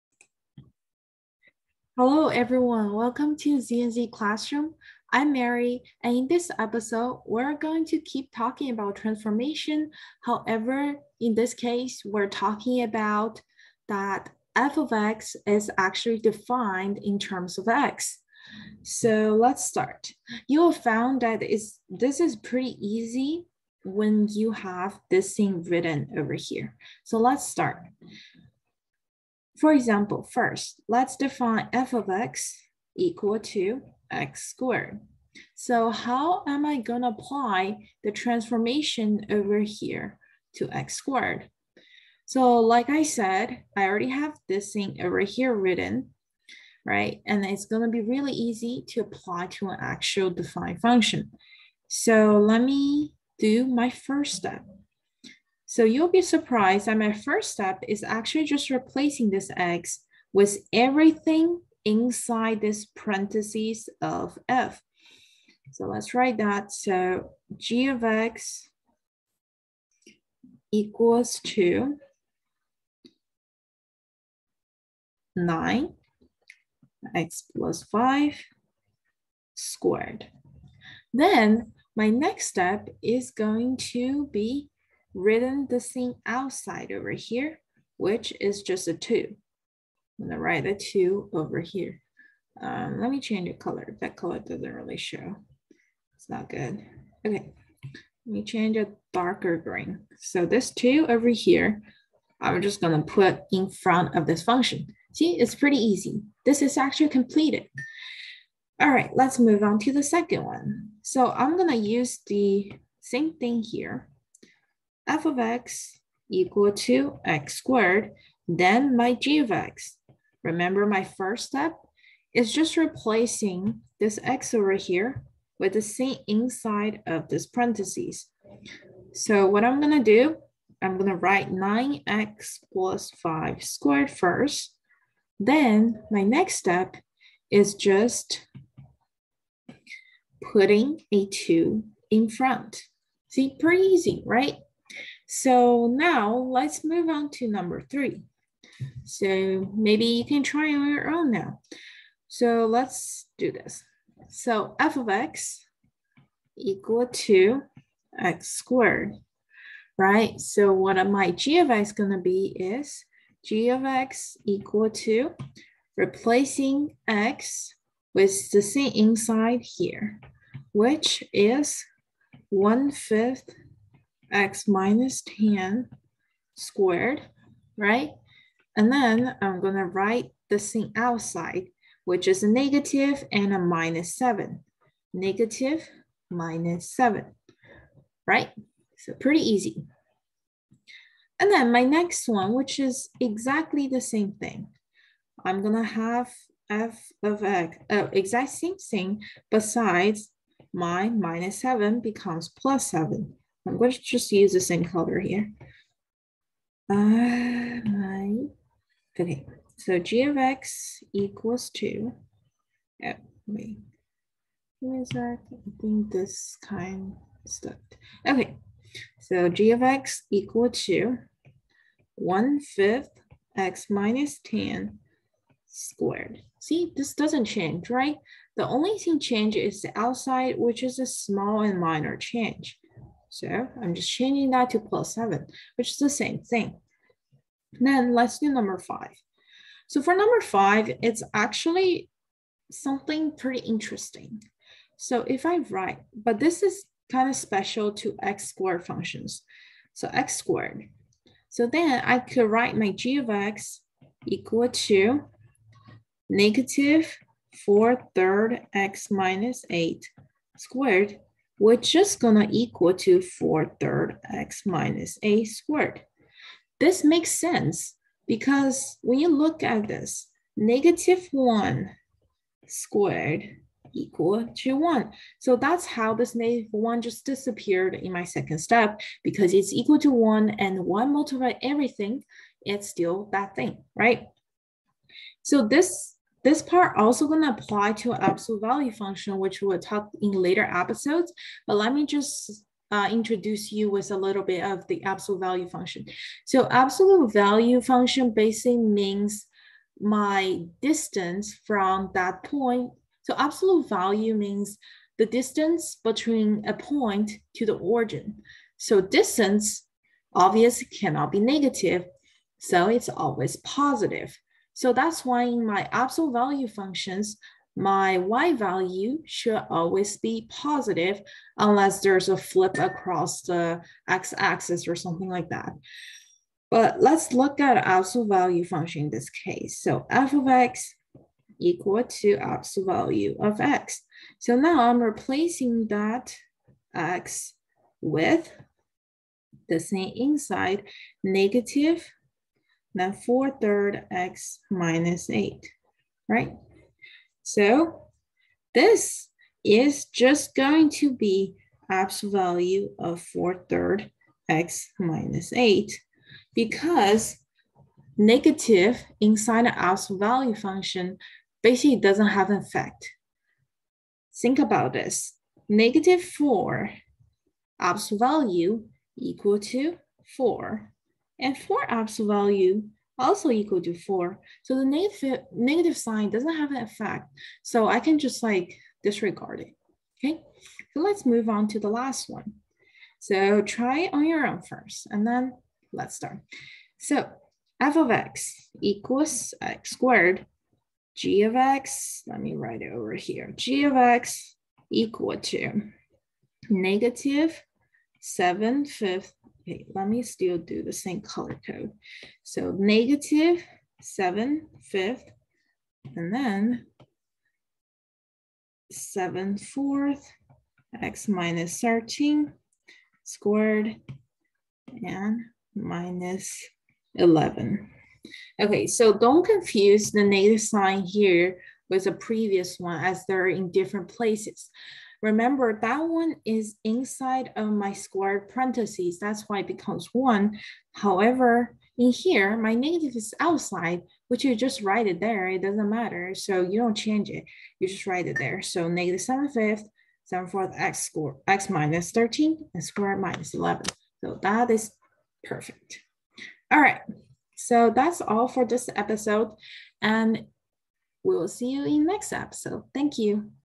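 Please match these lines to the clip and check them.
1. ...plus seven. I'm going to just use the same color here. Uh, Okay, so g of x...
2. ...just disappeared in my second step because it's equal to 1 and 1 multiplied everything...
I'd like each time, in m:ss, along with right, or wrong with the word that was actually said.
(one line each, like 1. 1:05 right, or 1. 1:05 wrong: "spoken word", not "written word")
1. 3:22 right
2. 4:37 right.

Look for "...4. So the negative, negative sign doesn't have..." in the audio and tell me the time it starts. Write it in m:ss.
6:13.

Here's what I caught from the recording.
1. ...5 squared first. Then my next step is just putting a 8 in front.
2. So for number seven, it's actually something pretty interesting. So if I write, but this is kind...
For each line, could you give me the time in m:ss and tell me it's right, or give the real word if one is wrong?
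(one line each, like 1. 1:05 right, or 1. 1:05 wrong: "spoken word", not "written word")
1. 2:13 wrong: "2", not "8"
2. 3:59 wrong: "five", not "seven".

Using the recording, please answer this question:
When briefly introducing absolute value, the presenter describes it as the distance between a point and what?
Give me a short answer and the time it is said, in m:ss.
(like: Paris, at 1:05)
the origin, at 5:07.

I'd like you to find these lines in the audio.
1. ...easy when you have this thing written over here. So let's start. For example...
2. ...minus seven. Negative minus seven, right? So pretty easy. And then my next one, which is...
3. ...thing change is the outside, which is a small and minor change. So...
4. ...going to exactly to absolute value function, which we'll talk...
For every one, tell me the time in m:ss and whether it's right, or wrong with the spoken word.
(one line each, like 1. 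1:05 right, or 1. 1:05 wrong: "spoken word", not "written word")
1. 0:22 right
2. 3:03 right
3. 3:48 right
4. 4:47 wrong: "apply", not "exactly".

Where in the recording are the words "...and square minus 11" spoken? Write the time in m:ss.
7:22.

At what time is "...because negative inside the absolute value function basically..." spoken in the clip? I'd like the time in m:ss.
5:56.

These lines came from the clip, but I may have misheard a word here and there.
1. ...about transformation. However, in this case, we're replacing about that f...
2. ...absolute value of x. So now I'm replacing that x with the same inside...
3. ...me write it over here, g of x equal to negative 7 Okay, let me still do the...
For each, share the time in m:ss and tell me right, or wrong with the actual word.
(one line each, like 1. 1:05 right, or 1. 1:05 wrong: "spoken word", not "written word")
1. 0:08 wrong: "talking", not "replacing"
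2. 5:32 right
3. 6:32 right.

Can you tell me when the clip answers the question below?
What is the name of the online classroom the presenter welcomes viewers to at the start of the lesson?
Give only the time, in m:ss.
0:03.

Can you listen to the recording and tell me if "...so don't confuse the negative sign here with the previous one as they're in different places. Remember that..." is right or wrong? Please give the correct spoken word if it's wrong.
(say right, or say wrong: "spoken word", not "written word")
right.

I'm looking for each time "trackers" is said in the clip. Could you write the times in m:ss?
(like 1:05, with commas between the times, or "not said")
not said.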